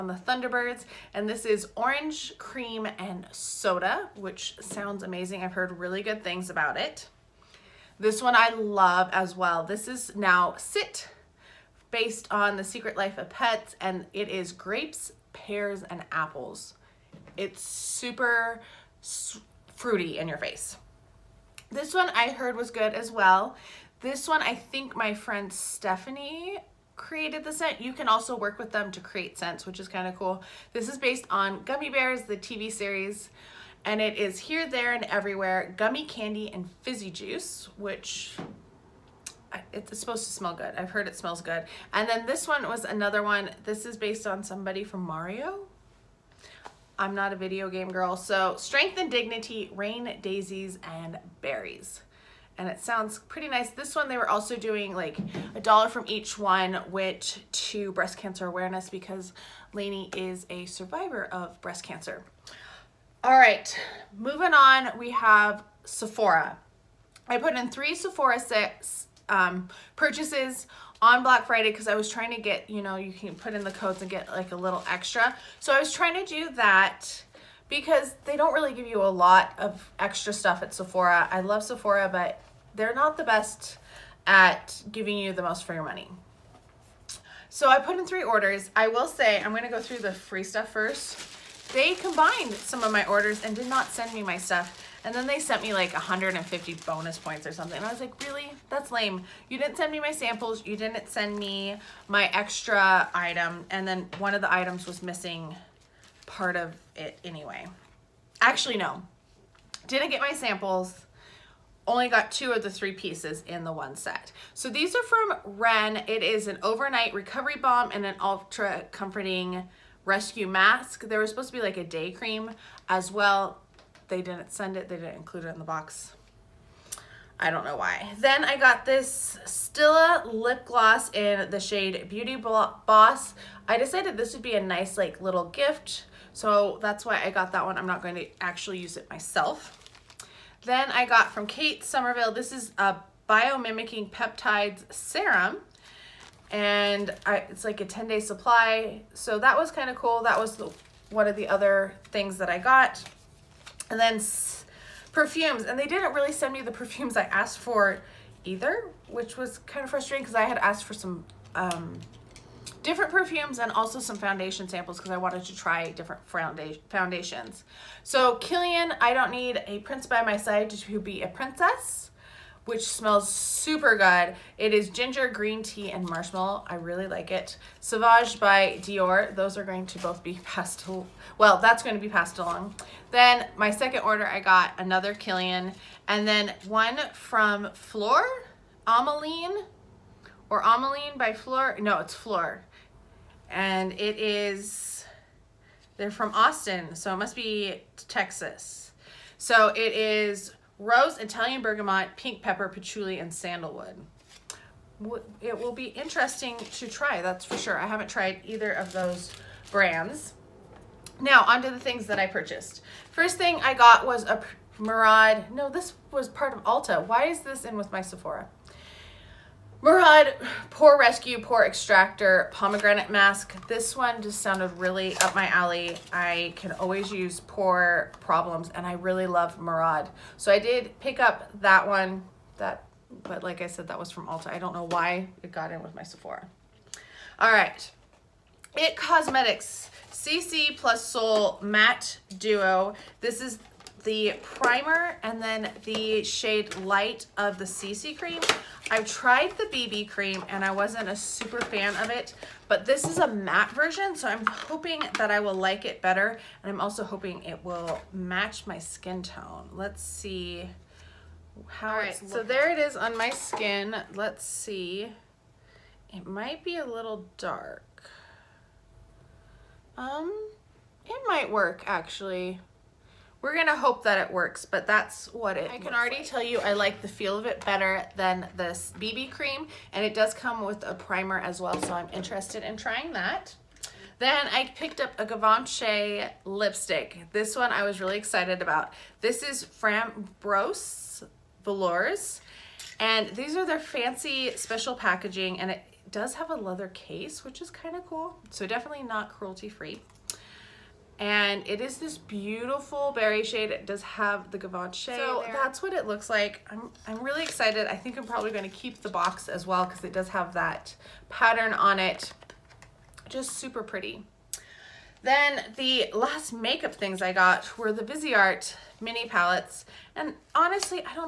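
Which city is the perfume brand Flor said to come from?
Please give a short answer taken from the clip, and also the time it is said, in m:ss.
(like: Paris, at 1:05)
Austin, at 3:16.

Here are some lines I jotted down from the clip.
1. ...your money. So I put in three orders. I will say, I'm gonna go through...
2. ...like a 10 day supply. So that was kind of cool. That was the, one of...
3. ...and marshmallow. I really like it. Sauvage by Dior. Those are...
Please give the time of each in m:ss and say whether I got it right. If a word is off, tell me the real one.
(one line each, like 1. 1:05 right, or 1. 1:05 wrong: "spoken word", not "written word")
1. 1:25 right
2. 2:27 right
3. 2:55 right.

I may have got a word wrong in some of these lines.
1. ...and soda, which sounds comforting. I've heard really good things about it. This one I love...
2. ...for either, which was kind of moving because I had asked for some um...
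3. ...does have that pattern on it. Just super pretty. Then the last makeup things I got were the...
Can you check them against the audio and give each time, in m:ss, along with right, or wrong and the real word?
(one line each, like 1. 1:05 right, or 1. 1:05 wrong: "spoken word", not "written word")
1. 0:02 wrong: "amazing", not "comforting"
2. 2:37 wrong: "frustrating", not "moving"
3. 5:10 right.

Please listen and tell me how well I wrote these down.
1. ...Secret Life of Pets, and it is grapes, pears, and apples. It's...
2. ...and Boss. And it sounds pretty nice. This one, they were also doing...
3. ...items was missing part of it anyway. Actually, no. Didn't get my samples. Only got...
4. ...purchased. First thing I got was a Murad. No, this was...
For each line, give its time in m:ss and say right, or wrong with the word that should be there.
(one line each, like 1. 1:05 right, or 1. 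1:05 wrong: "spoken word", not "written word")
1. 0:12 right
2. 0:50 wrong: "Berries", not "Boss"
3. 1:44 right
4. 3:32 right.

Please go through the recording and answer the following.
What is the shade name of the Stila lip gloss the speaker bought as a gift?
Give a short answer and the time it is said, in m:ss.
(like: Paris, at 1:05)
Beauty Boss, at 2:12.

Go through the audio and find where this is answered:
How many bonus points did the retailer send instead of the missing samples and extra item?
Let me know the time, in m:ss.
1:35.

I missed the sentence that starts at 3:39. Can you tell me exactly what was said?
Murad, Pore Rescue, Pore Extractor, Pomegranate Mask.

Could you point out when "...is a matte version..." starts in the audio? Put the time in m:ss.
4:13.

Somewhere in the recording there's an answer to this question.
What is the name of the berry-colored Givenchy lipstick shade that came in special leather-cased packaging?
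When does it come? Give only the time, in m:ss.
4:49.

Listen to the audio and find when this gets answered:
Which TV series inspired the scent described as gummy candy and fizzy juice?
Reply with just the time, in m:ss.
0:31.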